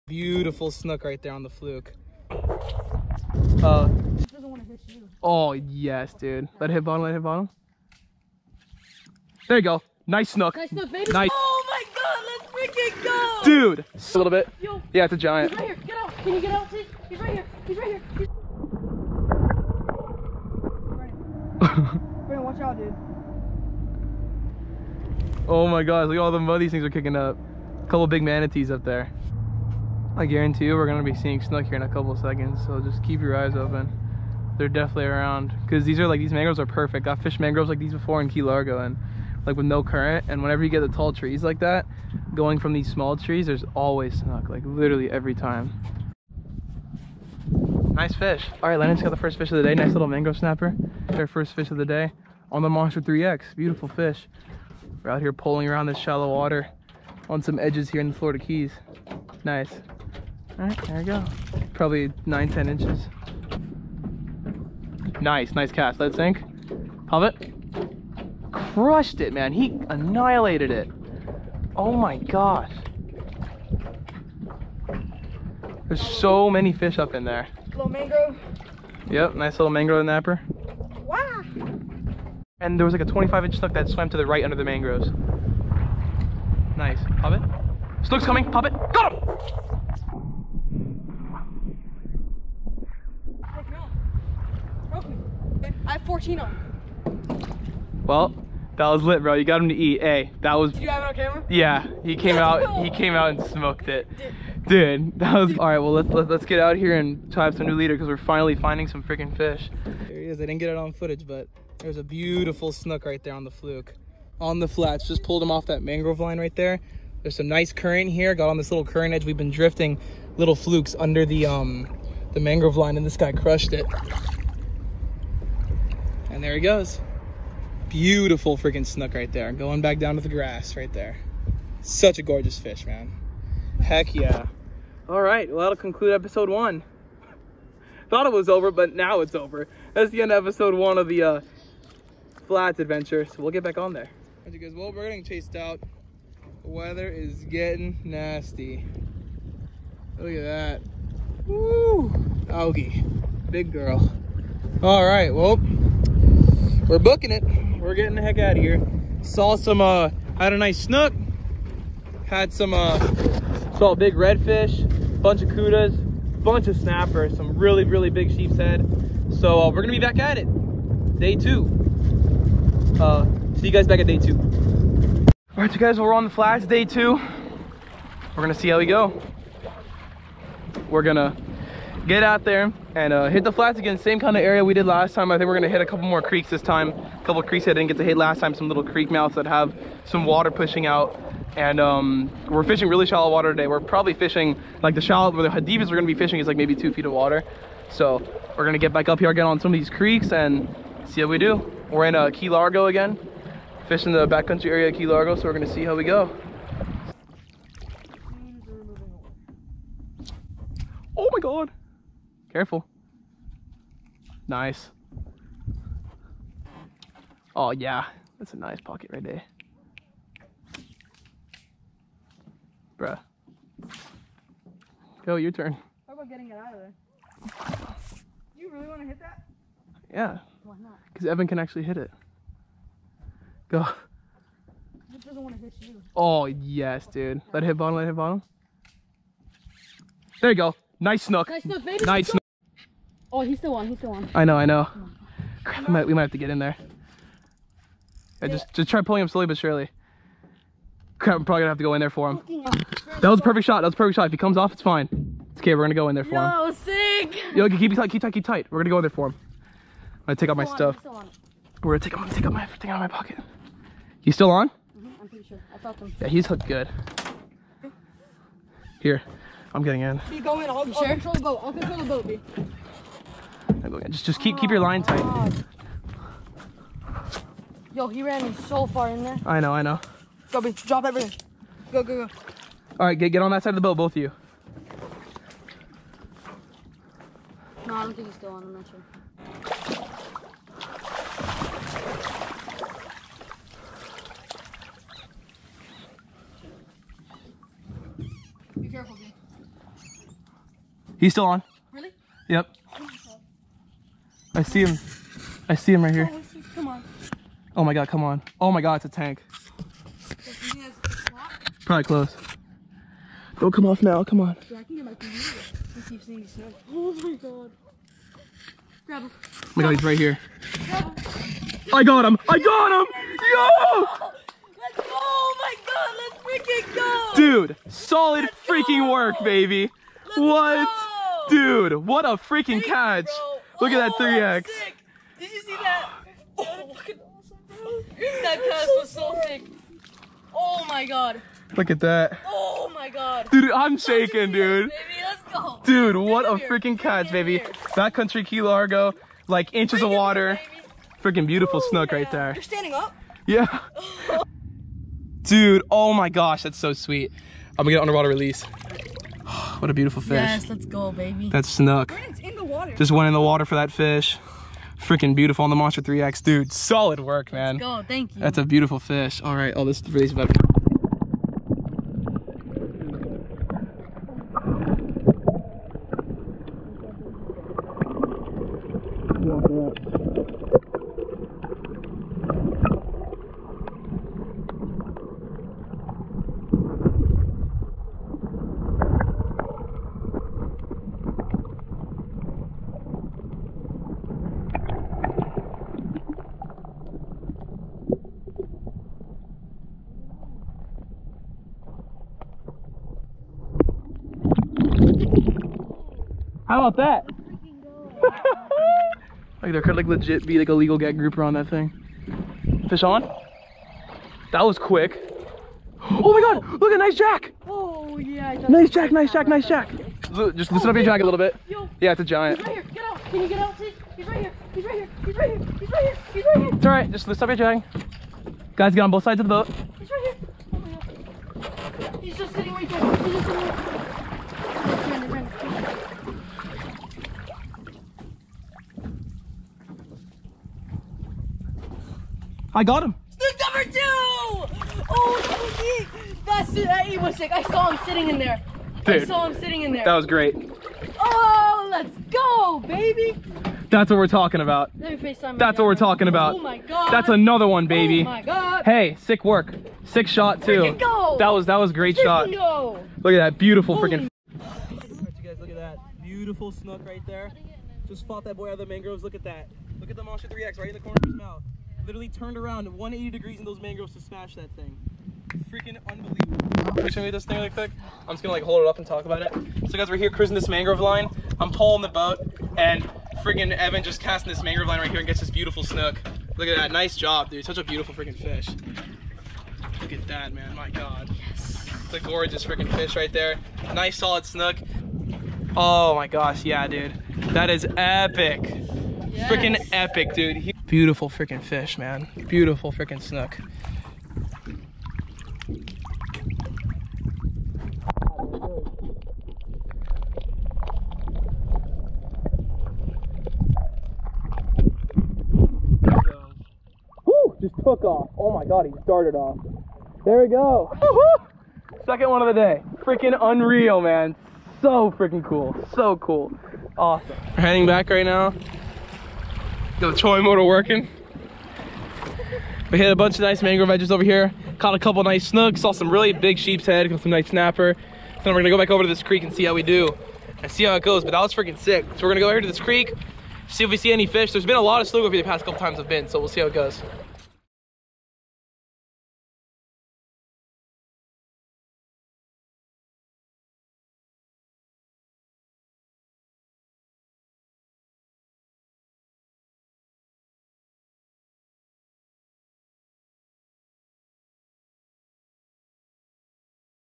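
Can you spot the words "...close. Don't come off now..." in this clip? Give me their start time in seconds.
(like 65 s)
312 s.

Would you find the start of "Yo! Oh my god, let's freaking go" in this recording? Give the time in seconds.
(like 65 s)
323 s.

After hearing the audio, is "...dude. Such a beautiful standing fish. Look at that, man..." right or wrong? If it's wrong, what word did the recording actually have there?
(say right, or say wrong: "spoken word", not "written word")
wrong: "freaking", not "standing".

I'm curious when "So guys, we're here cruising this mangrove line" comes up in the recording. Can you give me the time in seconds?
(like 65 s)
479 s.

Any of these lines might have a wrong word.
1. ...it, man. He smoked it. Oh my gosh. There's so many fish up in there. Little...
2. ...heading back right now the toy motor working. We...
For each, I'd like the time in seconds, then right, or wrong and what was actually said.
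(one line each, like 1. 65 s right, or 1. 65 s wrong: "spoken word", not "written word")
1. 69 s wrong: "annihilated", not "smoked"
2. 527 s right.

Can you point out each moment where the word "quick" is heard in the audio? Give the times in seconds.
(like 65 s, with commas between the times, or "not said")
414 s, 477 s.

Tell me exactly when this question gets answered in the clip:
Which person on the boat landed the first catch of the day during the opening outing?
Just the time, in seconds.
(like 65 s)
48 s.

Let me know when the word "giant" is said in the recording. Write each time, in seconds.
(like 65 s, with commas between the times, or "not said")
15 s, 422 s.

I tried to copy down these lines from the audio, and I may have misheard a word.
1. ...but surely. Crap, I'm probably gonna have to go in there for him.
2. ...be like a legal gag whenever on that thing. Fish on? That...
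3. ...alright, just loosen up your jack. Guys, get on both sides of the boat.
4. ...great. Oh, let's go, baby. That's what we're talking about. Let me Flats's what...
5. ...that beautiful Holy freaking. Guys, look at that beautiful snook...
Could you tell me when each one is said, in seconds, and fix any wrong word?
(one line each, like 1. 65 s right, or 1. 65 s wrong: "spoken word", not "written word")
1. 249 s right
2. 410 s wrong: "grouper", not "whenever"
3. 426 s right
4. 450 s wrong: "That", not "Flats"
5. 463 s right.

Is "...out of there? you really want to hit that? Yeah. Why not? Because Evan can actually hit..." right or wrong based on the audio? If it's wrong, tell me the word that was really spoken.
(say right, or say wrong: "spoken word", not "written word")
right.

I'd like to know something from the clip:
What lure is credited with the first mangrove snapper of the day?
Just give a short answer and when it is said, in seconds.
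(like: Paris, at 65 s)
Monster 3X, at 51 s.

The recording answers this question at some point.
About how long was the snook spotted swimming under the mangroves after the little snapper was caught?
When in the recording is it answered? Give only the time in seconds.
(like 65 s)
83 s.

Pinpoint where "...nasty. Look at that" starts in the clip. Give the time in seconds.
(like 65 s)
148 s.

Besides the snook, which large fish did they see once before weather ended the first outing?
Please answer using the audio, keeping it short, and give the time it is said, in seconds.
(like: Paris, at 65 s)
redfish, at 163 s.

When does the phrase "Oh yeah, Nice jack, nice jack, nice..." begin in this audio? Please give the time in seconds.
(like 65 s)
417 s.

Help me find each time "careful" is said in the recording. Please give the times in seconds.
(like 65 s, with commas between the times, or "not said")
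212 s, 298 s.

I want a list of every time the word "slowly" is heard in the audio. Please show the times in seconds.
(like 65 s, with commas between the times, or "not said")
249 s.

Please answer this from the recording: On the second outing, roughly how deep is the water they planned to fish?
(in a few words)
2 feet.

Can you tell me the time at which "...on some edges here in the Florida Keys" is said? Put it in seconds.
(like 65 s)
57 s.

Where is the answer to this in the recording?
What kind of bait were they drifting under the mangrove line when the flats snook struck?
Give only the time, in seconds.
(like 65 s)
120 s.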